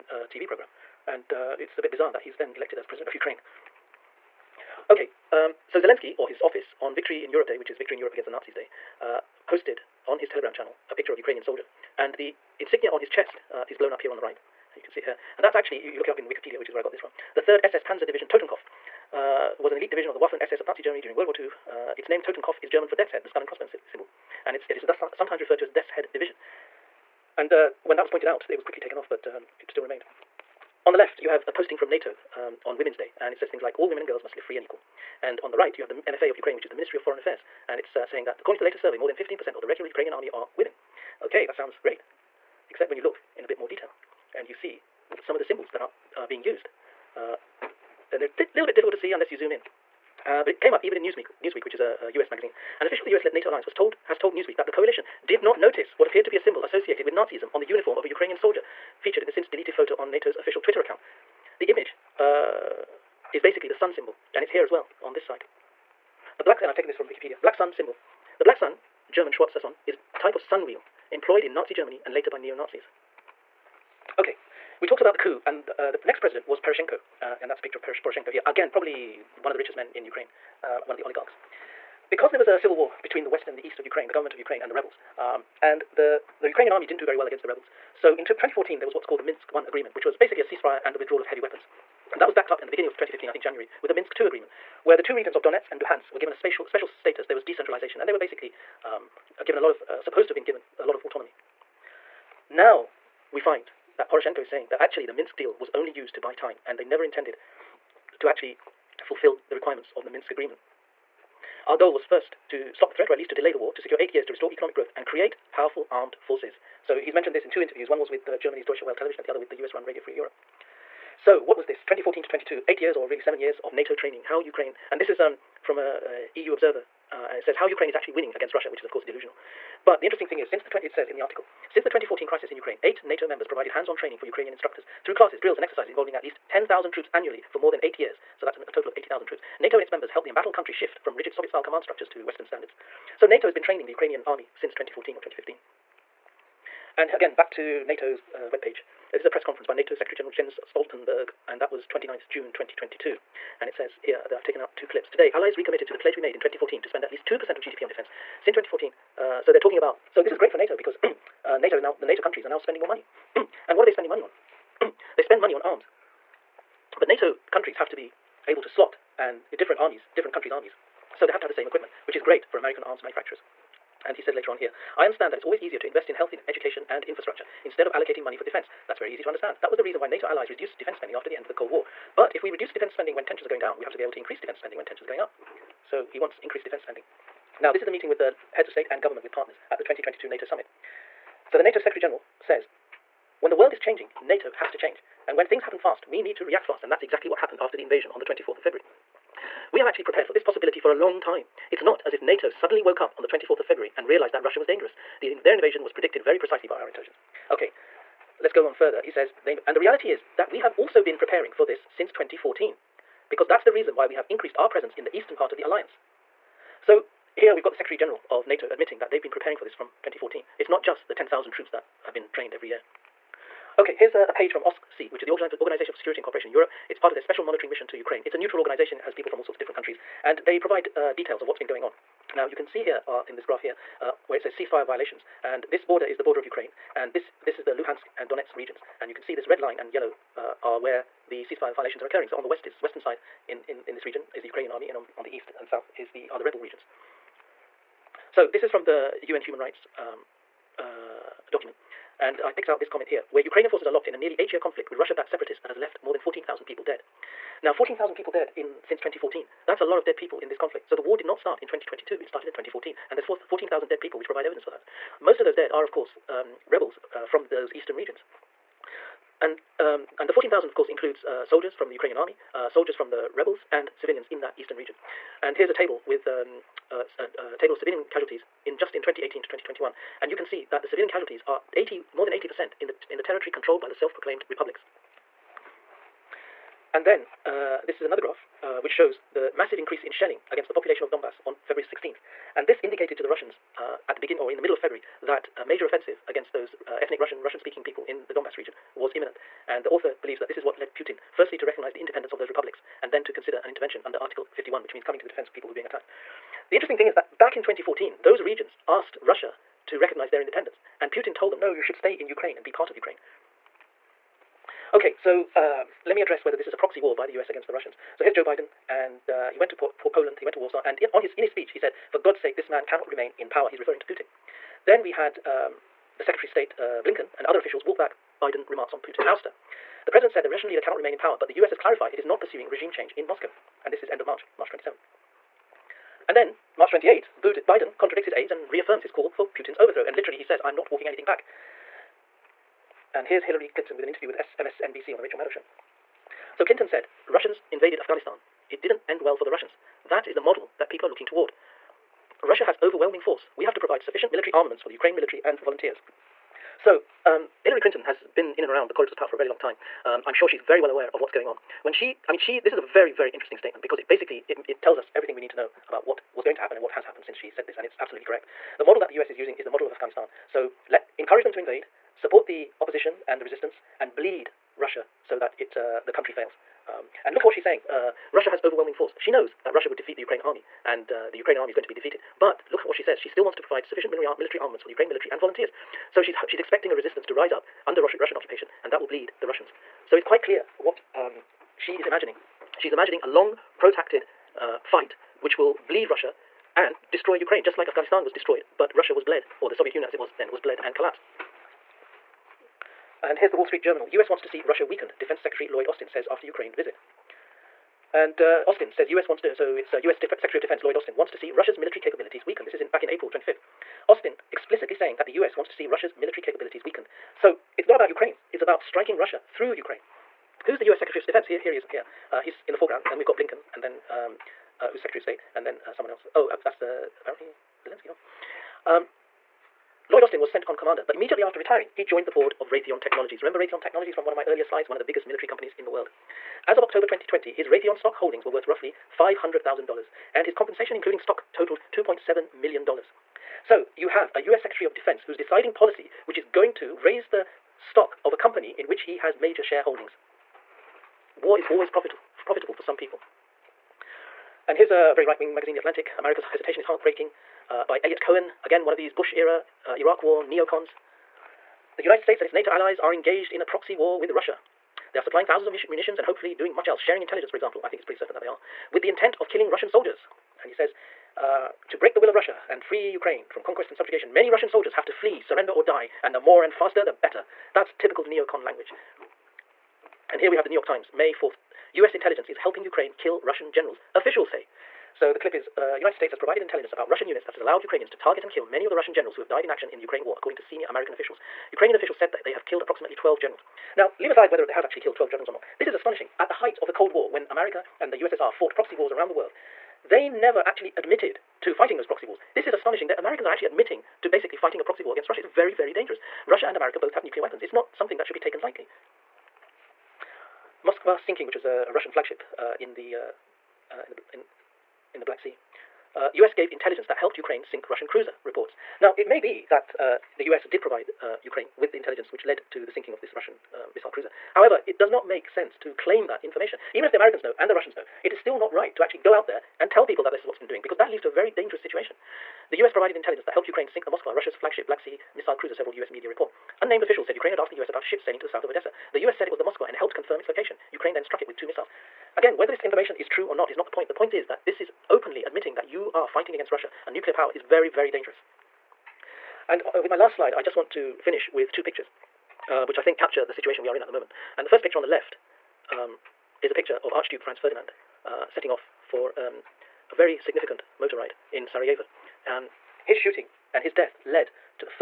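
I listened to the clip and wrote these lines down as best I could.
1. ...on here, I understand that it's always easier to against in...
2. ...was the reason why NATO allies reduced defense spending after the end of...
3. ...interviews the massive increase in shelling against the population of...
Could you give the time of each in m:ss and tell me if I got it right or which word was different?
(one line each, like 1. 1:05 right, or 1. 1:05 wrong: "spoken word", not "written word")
1. 2:54 wrong: "invest", not "against"
2. 2:59 right
3. 4:48 wrong: "shows", not "interviews".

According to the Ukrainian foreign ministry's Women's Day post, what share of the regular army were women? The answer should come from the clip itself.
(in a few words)
more than 15%.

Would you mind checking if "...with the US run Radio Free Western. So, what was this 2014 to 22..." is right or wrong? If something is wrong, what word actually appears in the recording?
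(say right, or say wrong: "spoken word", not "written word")
wrong: "Europe", not "Western".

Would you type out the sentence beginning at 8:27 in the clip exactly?
It's not something that should be taken lightly.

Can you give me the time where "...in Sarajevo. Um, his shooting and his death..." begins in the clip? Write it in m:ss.
9:21.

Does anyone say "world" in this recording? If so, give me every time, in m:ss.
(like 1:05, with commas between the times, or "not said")
0:21, 3:13, 7:15, 8:19.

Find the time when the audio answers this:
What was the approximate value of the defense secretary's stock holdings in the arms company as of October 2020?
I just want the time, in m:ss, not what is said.
7:19.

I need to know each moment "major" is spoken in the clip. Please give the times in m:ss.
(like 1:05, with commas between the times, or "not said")
4:55, 7:29.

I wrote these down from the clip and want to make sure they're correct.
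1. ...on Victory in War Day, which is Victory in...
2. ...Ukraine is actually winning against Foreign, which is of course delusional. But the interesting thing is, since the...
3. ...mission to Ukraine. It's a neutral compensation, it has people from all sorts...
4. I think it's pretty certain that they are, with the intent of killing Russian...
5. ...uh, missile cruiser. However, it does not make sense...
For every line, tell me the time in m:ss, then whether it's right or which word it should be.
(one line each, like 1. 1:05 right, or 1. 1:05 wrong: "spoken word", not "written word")
1. 0:06 wrong: "Europe", not "War"
2. 2:07 wrong: "Russia", not "Foreign"
3. 3:47 wrong: "organization", not "compensation"
4. 7:47 right
5. 8:43 right.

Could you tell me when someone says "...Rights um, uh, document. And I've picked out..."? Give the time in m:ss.
4:09.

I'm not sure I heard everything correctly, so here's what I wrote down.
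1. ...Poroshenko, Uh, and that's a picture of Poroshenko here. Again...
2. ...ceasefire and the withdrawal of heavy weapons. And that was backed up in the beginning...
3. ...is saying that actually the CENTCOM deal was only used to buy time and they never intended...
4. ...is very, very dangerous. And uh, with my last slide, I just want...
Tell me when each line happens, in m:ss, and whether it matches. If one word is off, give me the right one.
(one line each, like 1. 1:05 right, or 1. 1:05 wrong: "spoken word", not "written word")
1. 1:16 right
2. 1:30 right
3. 1:44 wrong: "Minsk", not "CENTCOM"
4. 9:07 right.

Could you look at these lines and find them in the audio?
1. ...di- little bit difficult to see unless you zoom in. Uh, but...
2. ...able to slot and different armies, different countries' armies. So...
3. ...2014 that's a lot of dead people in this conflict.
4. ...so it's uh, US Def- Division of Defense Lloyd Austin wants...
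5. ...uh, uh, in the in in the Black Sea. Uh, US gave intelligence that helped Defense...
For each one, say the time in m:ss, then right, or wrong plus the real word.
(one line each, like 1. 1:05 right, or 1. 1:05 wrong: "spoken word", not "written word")
1. 0:48 right
2. 2:48 right
3. 4:18 right
4. 6:49 wrong: "Secretary", not "Division"
5. 8:33 wrong: "Ukraine", not "Defense".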